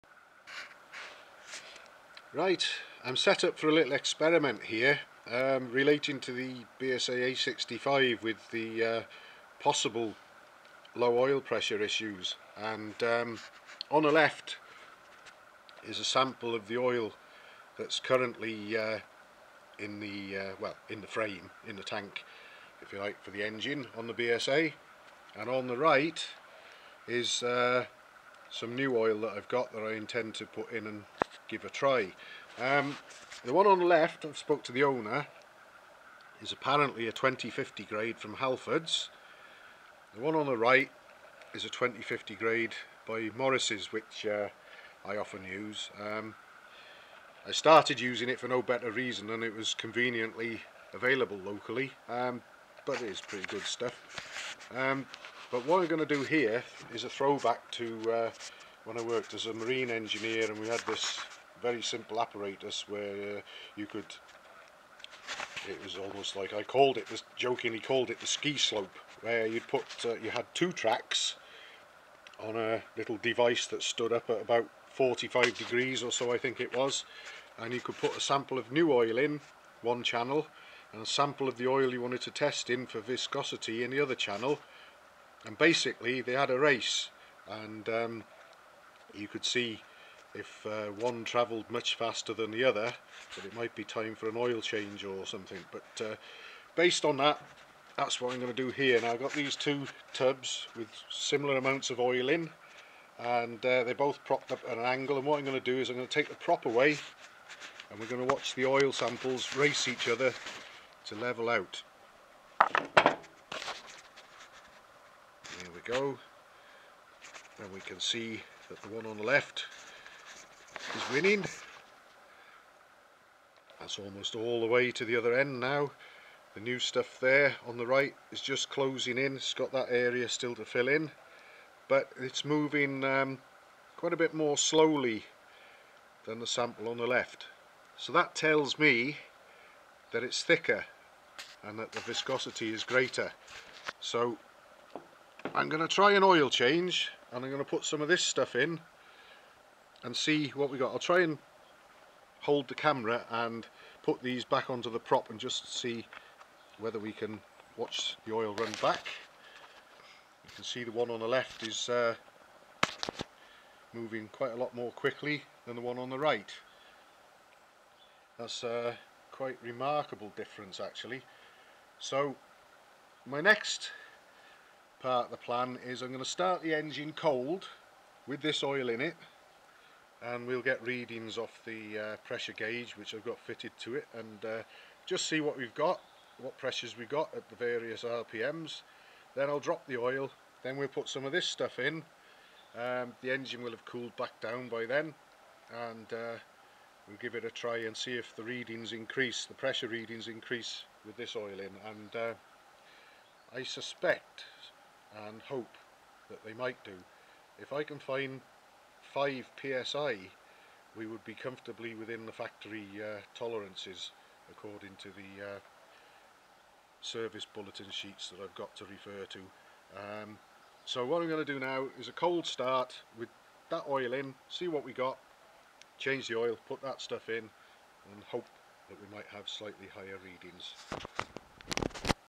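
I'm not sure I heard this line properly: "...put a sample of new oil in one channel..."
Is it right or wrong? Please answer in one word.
right.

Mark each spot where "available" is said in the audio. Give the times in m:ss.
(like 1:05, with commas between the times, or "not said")
0:50.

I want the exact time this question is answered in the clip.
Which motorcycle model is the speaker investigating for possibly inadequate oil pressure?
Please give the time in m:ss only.
0:06.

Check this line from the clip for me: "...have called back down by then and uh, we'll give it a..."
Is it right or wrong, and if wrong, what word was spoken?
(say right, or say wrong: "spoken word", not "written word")
wrong: "cooled", not "called".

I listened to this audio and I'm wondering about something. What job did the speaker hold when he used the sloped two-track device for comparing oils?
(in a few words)
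Marine engineer.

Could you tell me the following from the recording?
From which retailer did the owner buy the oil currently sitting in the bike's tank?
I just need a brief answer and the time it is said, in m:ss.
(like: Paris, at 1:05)
Halfords, at 0:38.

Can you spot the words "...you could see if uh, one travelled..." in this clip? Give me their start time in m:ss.
1:29.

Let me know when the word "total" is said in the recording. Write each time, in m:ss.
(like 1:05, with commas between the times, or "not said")
not said.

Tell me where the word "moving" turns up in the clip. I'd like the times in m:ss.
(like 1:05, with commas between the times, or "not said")
2:12, 2:43.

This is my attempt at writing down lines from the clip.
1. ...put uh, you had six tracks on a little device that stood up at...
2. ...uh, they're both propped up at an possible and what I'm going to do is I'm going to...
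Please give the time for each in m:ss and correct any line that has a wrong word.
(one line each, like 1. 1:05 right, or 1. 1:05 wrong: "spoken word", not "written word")
1. 1:09 wrong: "two", not "six"
2. 1:43 wrong: "angle", not "possible".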